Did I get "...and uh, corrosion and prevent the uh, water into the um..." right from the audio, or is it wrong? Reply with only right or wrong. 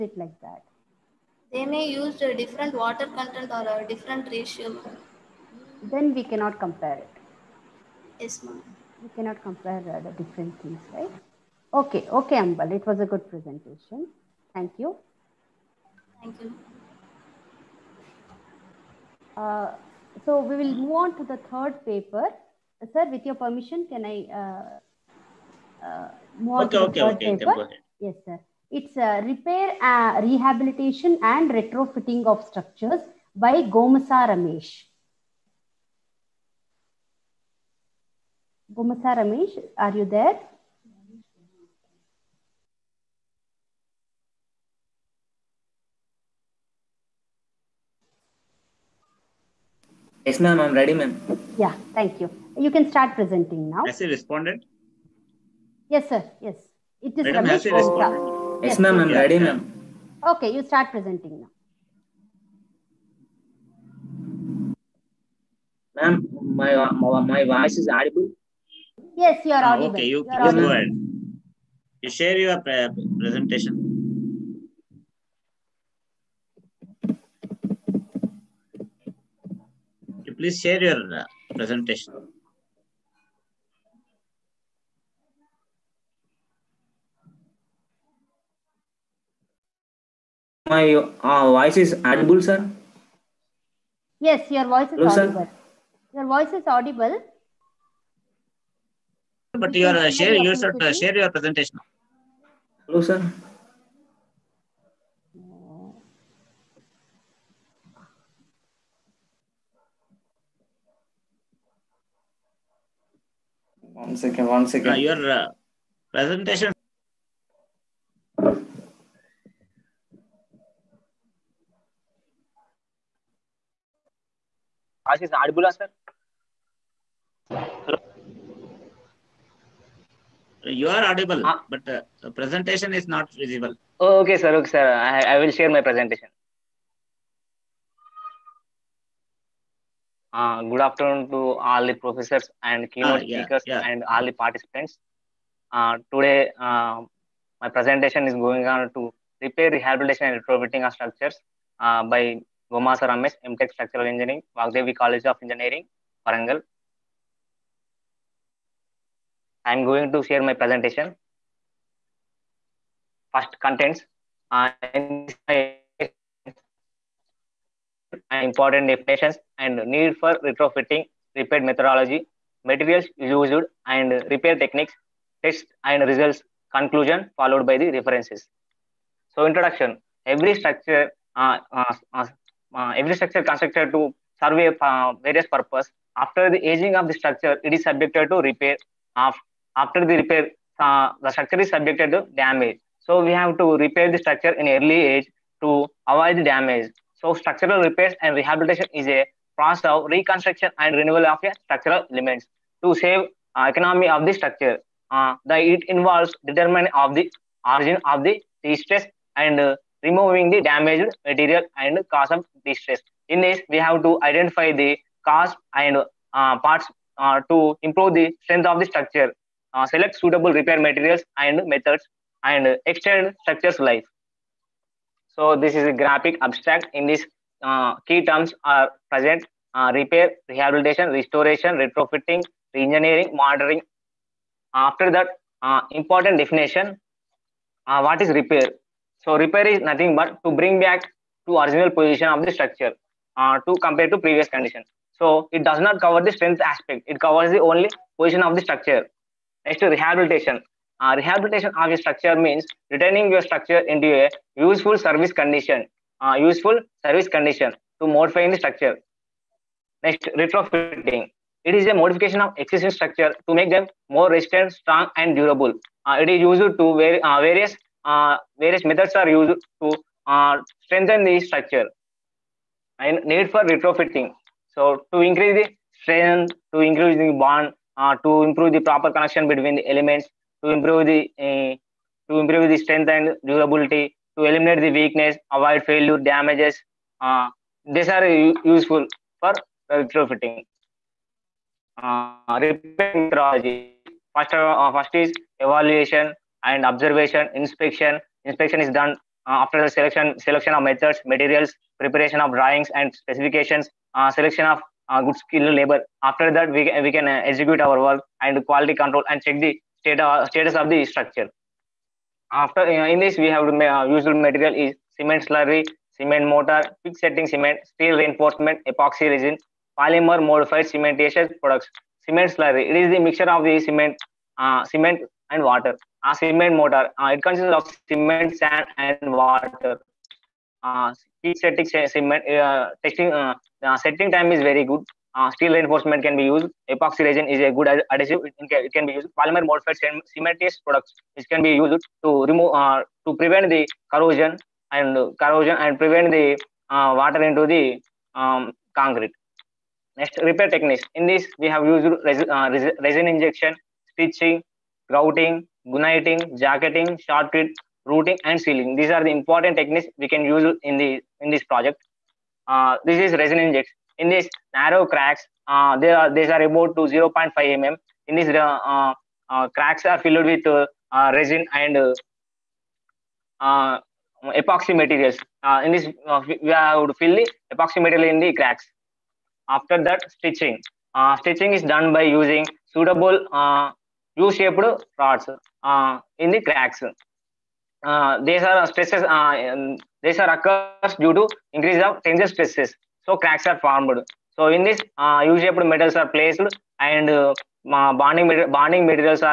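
right.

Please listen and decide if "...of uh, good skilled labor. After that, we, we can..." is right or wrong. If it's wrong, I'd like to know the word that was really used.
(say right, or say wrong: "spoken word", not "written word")
right.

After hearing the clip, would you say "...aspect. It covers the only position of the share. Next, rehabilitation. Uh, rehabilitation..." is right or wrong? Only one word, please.
wrong.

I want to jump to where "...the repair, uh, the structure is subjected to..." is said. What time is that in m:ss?
3:10.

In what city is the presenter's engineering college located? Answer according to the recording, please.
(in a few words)
Warangal.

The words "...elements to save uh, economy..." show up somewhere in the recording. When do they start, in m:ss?
3:22.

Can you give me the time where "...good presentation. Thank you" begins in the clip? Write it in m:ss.
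0:13.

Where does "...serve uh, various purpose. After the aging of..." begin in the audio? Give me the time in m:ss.
3:04.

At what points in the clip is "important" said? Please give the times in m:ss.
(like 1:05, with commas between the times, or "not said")
2:48, 3:55, 5:59.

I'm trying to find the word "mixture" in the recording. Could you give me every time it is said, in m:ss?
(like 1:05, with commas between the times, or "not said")
5:23.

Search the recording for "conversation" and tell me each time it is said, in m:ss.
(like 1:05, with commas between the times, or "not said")
not said.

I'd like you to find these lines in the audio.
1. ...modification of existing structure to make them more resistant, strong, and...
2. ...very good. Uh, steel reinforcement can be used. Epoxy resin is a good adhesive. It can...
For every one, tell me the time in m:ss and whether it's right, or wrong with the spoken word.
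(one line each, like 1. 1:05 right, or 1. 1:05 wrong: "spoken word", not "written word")
1. 4:21 right
2. 5:34 right.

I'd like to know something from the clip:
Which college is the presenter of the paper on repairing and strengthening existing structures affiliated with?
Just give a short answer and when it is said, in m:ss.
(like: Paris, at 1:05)
Vagdevi College of Engineering, at 2:34.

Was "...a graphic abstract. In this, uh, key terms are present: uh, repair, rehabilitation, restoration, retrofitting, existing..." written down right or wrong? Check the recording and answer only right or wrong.
wrong.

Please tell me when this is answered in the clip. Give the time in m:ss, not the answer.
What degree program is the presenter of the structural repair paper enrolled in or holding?
2:33.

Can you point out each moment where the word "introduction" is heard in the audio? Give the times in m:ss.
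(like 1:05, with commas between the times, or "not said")
2:59.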